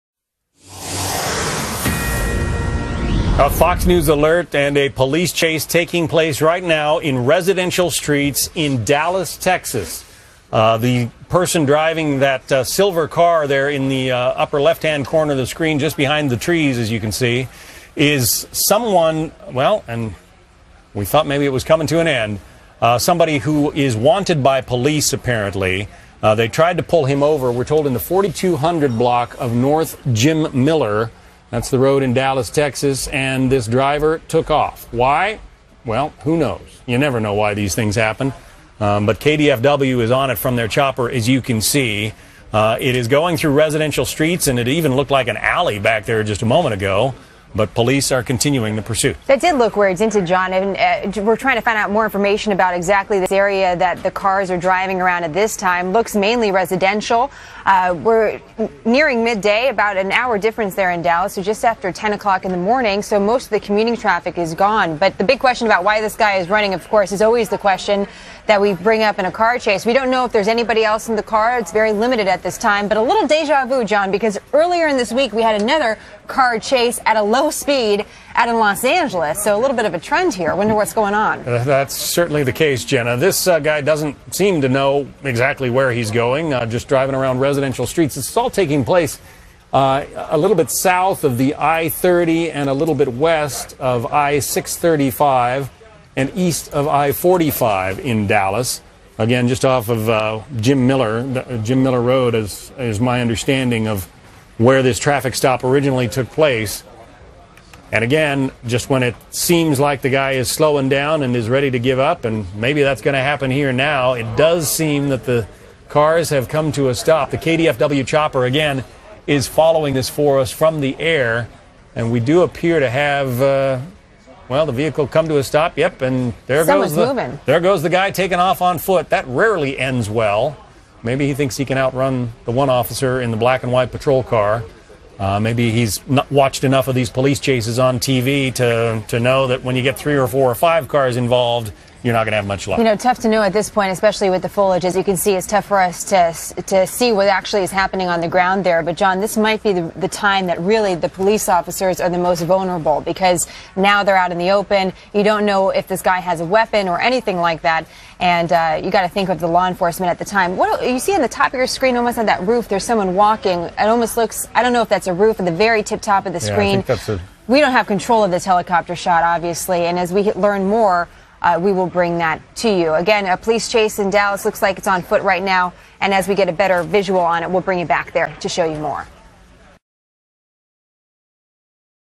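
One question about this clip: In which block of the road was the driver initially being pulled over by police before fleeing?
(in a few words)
4200 block.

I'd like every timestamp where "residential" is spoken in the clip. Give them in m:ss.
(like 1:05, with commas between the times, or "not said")
0:07, 0:43, 0:56, 1:27.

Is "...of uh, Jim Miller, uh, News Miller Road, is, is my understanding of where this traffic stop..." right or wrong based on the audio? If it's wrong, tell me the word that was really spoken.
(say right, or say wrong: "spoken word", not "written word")
wrong: "Jim", not "News".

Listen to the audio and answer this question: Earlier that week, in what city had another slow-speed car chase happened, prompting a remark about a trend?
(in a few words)
Los Angeles.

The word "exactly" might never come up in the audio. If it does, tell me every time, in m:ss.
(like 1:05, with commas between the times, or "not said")
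0:52, 1:25.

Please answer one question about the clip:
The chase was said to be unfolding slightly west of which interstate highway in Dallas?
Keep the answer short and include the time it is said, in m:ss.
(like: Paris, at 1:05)
I-635, at 1:34.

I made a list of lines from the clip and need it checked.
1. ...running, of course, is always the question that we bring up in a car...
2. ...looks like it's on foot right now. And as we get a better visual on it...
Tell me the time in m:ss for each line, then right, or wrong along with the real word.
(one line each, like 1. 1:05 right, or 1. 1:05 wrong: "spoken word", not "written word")
1. 1:06 right
2. 2:54 right.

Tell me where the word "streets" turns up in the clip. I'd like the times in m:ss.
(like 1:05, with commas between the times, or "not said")
0:07, 0:44, 1:27.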